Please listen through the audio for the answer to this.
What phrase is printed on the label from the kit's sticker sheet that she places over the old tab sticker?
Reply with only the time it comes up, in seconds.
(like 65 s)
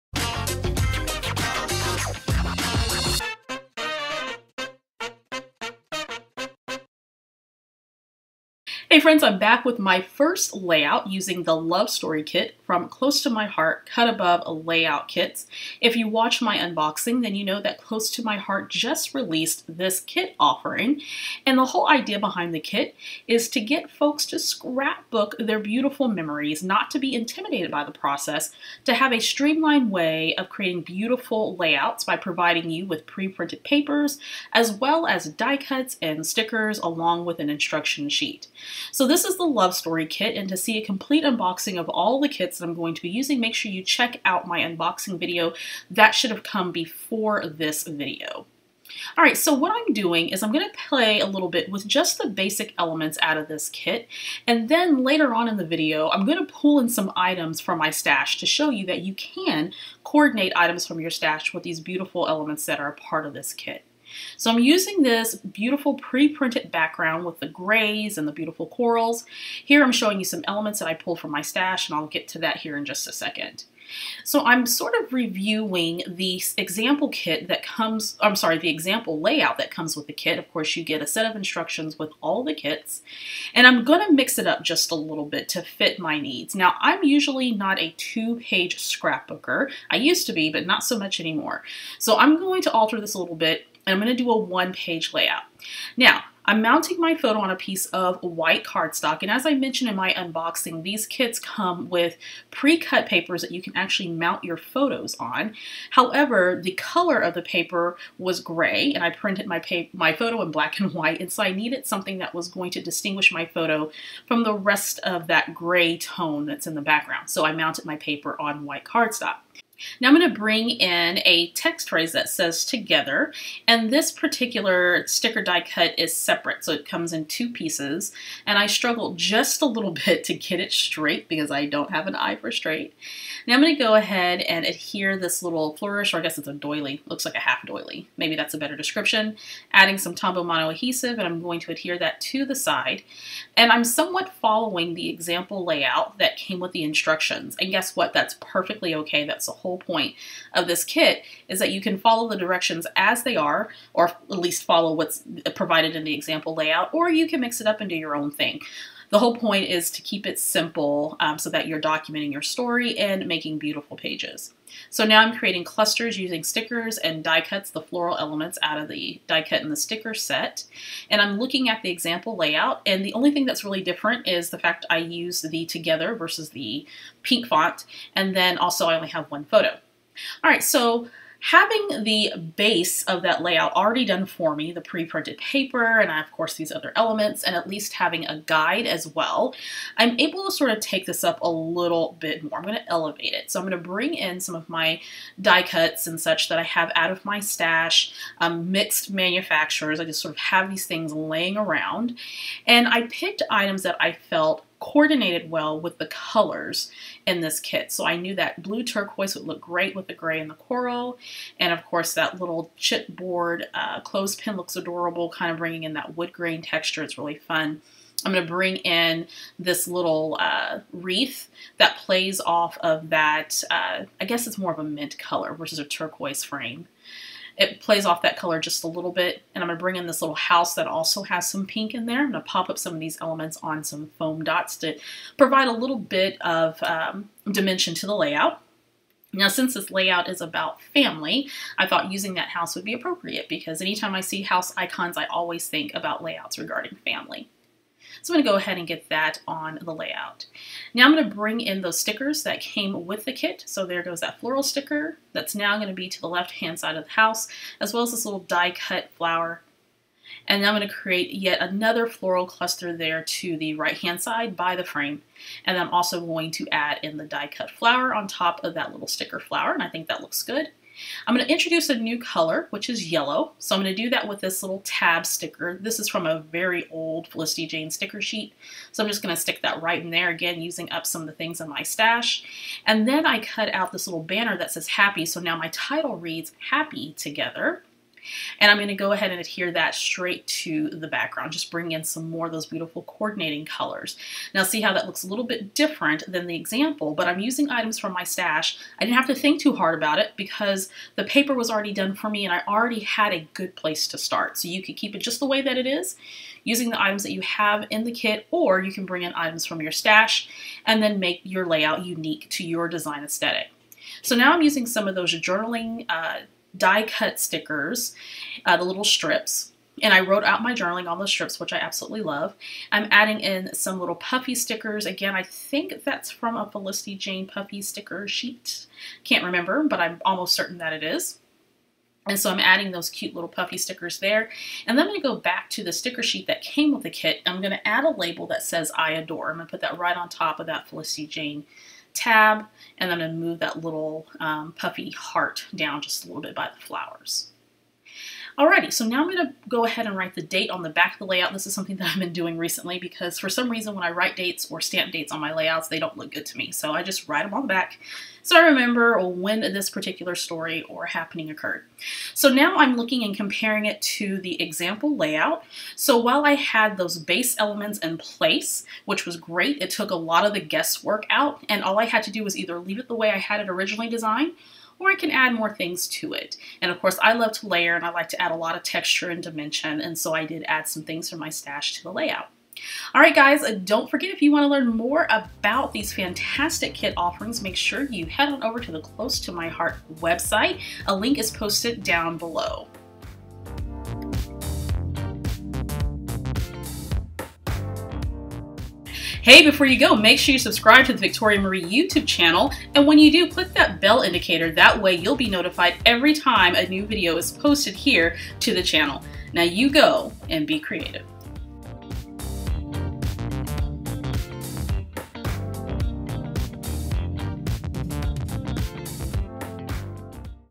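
338 s.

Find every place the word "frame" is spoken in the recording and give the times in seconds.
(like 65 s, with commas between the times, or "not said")
226 s, 264 s.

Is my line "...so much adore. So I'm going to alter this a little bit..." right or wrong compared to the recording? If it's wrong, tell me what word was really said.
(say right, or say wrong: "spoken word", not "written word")
wrong: "anymore", not "adore".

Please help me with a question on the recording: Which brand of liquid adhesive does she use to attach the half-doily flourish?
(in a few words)
Tombow Mono.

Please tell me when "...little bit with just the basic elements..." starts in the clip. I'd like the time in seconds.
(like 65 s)
51 s.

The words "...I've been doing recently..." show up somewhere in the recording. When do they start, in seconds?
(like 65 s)
352 s.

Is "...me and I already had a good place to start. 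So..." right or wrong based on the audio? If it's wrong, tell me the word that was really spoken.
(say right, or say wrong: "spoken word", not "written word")
right.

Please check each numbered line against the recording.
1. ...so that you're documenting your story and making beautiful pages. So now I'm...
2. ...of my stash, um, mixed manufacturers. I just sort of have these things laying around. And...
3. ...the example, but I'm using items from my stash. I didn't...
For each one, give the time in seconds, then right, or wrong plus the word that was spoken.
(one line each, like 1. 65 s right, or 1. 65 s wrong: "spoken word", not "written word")
1. 161 s right
2. 197 s right
3. 296 s right.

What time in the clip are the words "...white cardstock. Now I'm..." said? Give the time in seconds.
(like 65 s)
118 s.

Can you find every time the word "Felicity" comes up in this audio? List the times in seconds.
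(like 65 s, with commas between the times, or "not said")
277 s, 326 s, 340 s.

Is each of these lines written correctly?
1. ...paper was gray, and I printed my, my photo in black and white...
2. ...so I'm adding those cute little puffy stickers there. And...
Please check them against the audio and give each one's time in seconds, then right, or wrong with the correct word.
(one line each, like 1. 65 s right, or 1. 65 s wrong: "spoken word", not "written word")
1. 107 s right
2. 332 s right.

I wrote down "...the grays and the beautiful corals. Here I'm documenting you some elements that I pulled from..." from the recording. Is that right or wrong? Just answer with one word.
wrong.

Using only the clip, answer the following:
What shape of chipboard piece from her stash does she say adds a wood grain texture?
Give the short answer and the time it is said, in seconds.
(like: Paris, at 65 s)
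Clothespin, at 214 s.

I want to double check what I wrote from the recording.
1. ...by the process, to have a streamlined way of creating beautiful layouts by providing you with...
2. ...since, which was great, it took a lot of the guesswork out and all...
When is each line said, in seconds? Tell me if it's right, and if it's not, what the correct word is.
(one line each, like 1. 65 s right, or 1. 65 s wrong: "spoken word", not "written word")
1. 27 s right
2. 368 s wrong: "place", not "since".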